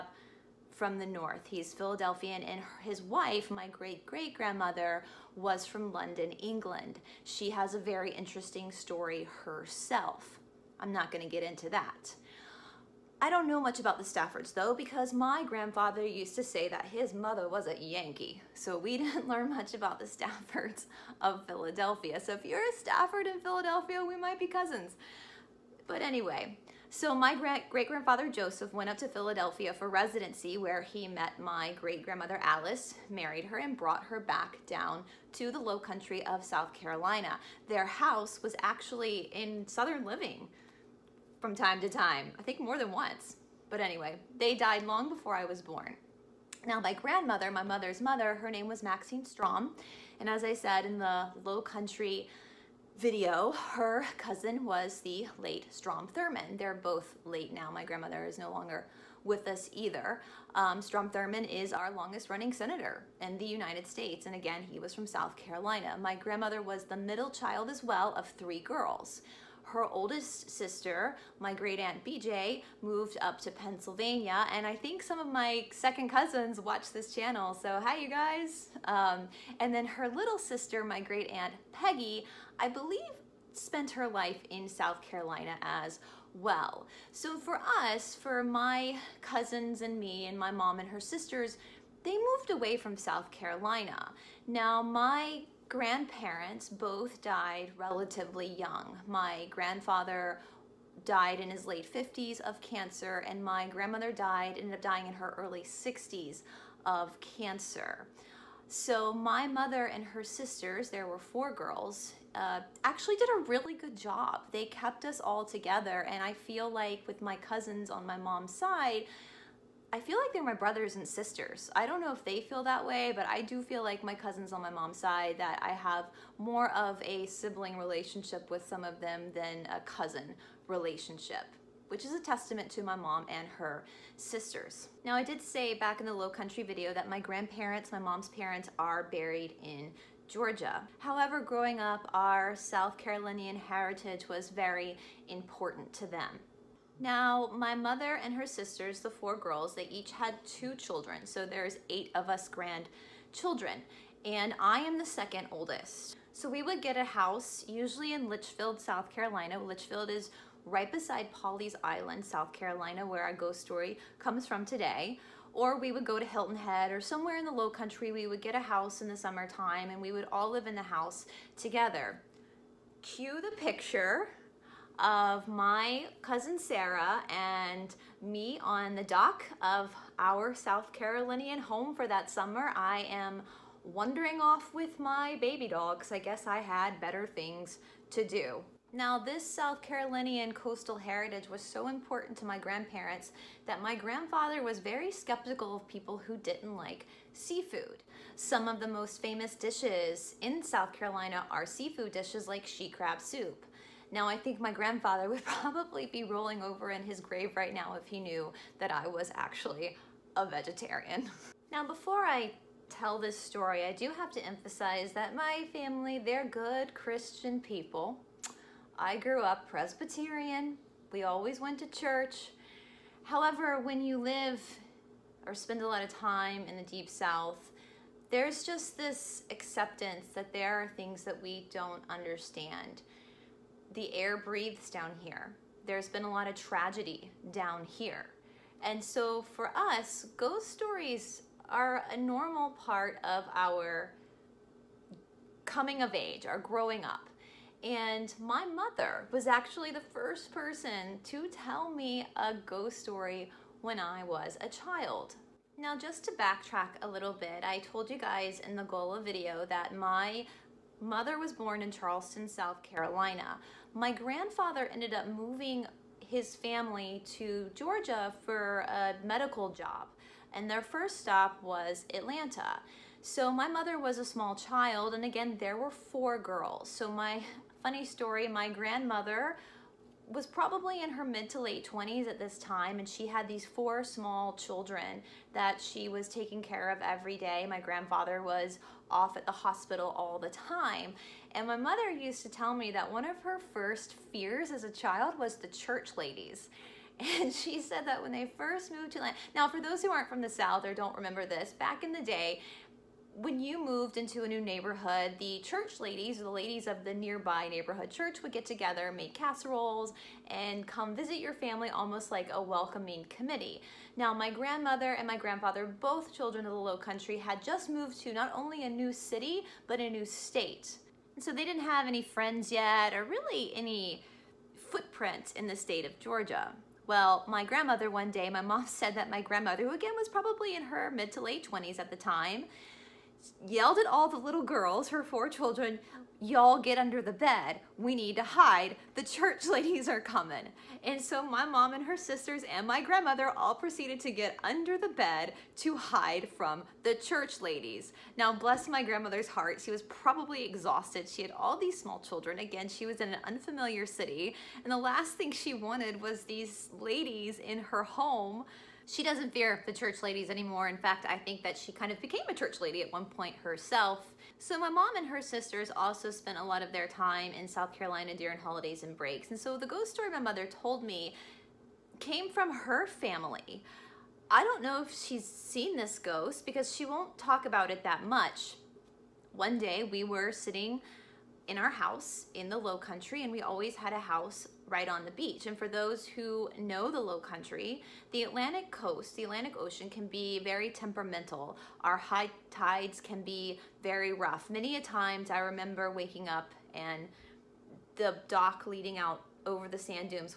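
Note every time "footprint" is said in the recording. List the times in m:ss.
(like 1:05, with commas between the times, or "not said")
5:24.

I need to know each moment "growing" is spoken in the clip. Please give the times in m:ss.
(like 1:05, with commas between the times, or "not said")
2:21, 4:06.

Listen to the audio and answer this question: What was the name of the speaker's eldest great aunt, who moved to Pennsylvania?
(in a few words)
BJ.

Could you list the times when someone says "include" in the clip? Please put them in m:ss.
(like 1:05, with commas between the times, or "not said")
not said.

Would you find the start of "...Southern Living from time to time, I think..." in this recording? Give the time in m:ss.
0:39.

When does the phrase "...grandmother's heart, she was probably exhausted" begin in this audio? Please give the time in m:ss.
5:49.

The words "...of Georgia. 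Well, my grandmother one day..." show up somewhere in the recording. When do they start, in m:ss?
5:26.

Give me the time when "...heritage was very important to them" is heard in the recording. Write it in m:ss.
2:23.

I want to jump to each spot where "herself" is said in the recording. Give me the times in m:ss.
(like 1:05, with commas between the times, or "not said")
0:09, 6:03.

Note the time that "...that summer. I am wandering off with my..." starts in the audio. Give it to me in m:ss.
3:02.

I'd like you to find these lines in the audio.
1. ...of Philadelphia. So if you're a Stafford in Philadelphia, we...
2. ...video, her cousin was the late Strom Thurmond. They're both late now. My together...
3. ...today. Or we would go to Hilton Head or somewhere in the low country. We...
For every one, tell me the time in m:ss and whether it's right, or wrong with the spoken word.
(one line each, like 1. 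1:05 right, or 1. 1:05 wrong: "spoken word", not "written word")
1. 0:21 right
2. 0:52 wrong: "grandmother", not "together"
3. 2:44 right.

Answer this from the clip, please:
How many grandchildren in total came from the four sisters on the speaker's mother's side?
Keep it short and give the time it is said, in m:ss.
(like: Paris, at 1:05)
8, at 2:31.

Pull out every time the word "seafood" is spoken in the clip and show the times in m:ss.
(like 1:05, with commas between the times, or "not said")
3:17, 3:21.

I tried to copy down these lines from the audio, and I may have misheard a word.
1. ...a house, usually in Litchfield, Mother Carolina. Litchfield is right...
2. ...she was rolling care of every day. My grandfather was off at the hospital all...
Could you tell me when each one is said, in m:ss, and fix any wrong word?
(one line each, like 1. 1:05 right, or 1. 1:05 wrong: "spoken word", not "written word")
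1. 2:36 wrong: "South", not "Mother"
2. 4:45 wrong: "taking", not "rolling".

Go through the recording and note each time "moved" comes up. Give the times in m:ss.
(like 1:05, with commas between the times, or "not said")
1:12, 1:32, 4:58, 5:03, 5:17.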